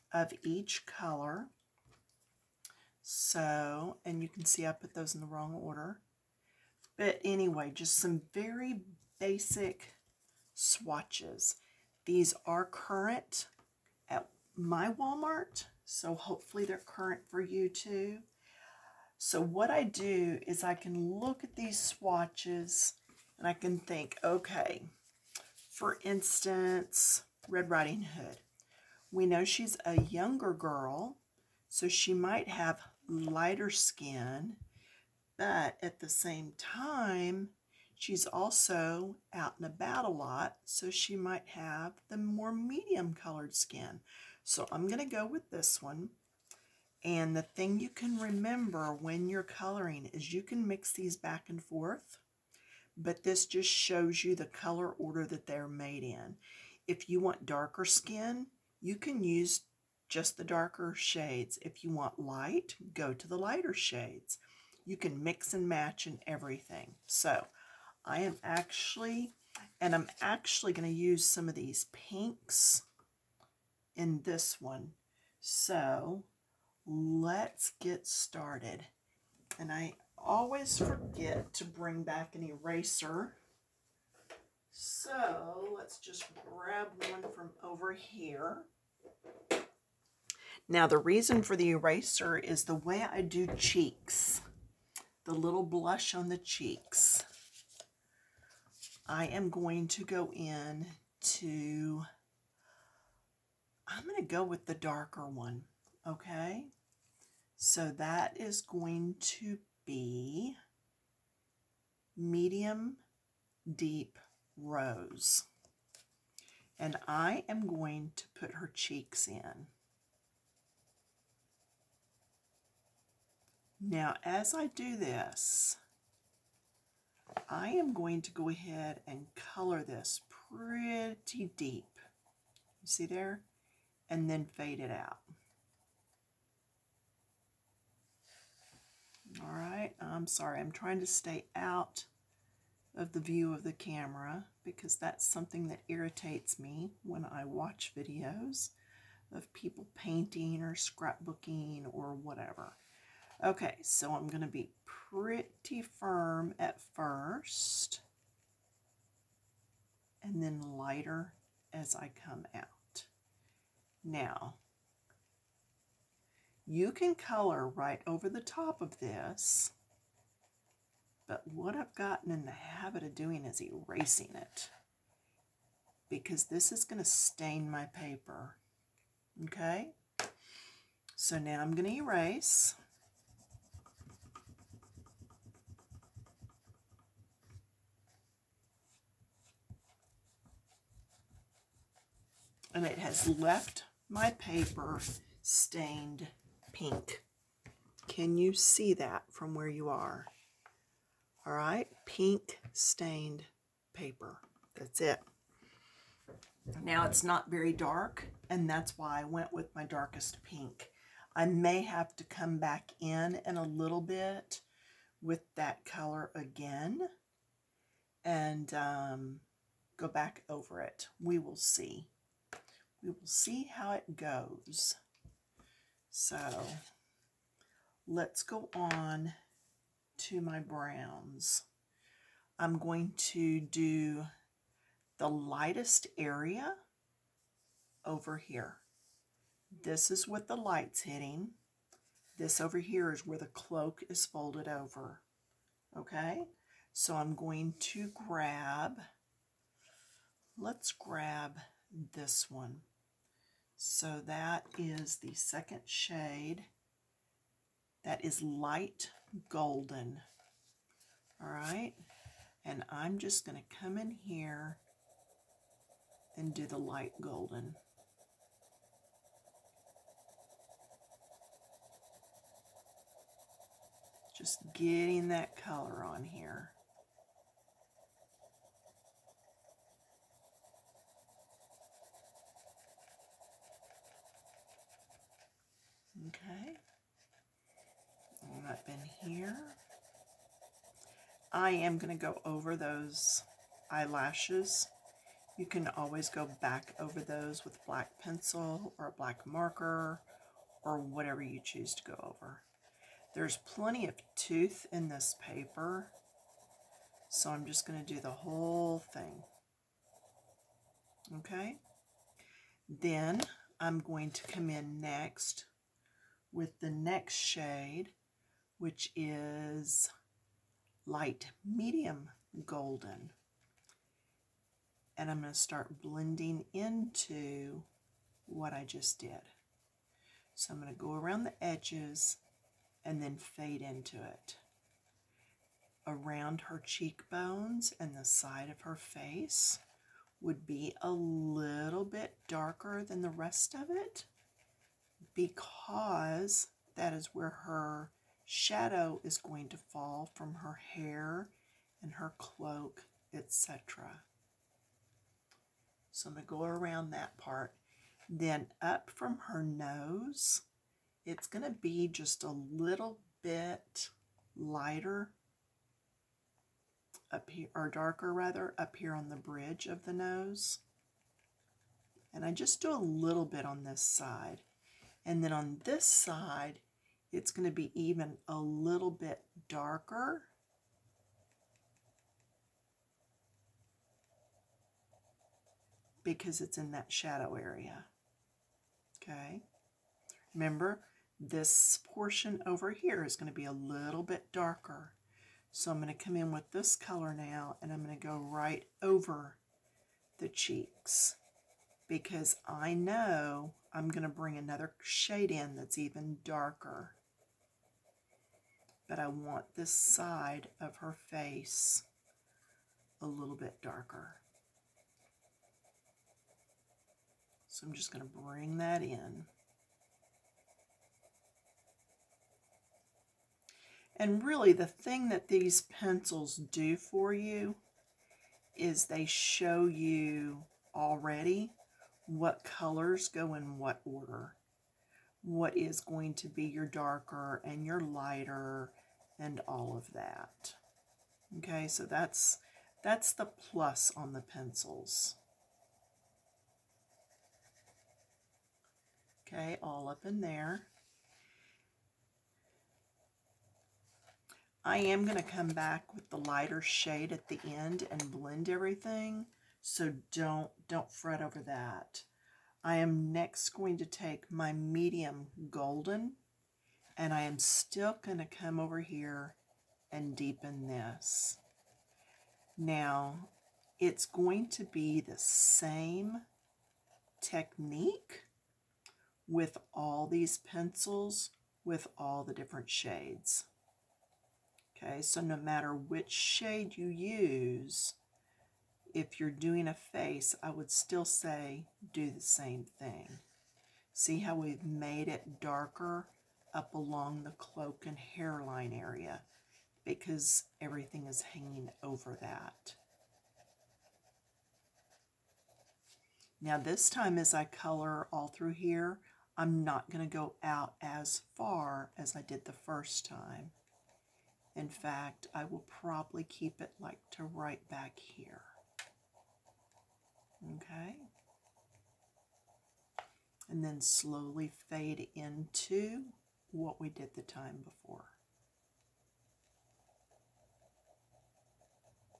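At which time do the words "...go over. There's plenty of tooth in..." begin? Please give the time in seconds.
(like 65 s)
302 s.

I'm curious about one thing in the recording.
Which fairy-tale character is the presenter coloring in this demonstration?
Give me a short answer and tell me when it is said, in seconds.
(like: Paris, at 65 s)
Red Riding Hood, at 27 s.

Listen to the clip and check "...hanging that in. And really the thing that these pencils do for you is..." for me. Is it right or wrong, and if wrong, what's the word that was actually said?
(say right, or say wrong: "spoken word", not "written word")
wrong: "bring", not "hanging".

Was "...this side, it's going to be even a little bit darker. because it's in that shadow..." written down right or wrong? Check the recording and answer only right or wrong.
right.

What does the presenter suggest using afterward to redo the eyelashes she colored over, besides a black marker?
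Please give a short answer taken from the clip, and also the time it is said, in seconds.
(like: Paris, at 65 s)
black pencil, at 297 s.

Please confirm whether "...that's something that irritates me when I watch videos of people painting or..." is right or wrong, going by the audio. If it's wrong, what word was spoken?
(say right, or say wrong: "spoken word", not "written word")
right.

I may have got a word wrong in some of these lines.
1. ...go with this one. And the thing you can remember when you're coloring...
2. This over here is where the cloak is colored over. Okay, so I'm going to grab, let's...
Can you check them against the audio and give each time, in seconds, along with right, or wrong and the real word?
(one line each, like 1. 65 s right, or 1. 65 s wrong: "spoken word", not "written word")
1. 45 s right
2. 242 s wrong: "folded", not "colored".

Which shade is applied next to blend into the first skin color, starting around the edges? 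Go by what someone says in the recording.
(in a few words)
light medium golden.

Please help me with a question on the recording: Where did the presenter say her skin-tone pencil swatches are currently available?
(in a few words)
Walmart.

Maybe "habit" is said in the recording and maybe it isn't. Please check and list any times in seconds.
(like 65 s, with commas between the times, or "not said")
172 s.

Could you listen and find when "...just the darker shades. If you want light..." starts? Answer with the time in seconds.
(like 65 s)
60 s.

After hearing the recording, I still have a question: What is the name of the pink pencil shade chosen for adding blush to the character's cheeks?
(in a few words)
medium deep rose.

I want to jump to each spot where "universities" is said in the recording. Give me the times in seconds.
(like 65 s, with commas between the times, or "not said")
not said.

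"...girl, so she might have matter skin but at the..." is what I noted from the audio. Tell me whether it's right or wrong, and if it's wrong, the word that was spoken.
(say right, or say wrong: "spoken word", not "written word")
wrong: "lighter", not "matter".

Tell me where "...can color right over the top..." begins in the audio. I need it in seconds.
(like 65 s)
166 s.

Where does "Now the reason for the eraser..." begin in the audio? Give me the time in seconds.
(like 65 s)
90 s.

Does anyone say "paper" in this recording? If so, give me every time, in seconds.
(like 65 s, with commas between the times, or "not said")
177 s, 194 s, 203 s, 305 s.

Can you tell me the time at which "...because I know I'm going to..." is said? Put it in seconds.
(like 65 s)
402 s.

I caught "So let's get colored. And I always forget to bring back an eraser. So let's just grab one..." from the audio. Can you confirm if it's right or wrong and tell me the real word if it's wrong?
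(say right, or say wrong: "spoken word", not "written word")
wrong: "started", not "colored".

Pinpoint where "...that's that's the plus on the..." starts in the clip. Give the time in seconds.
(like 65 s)
442 s.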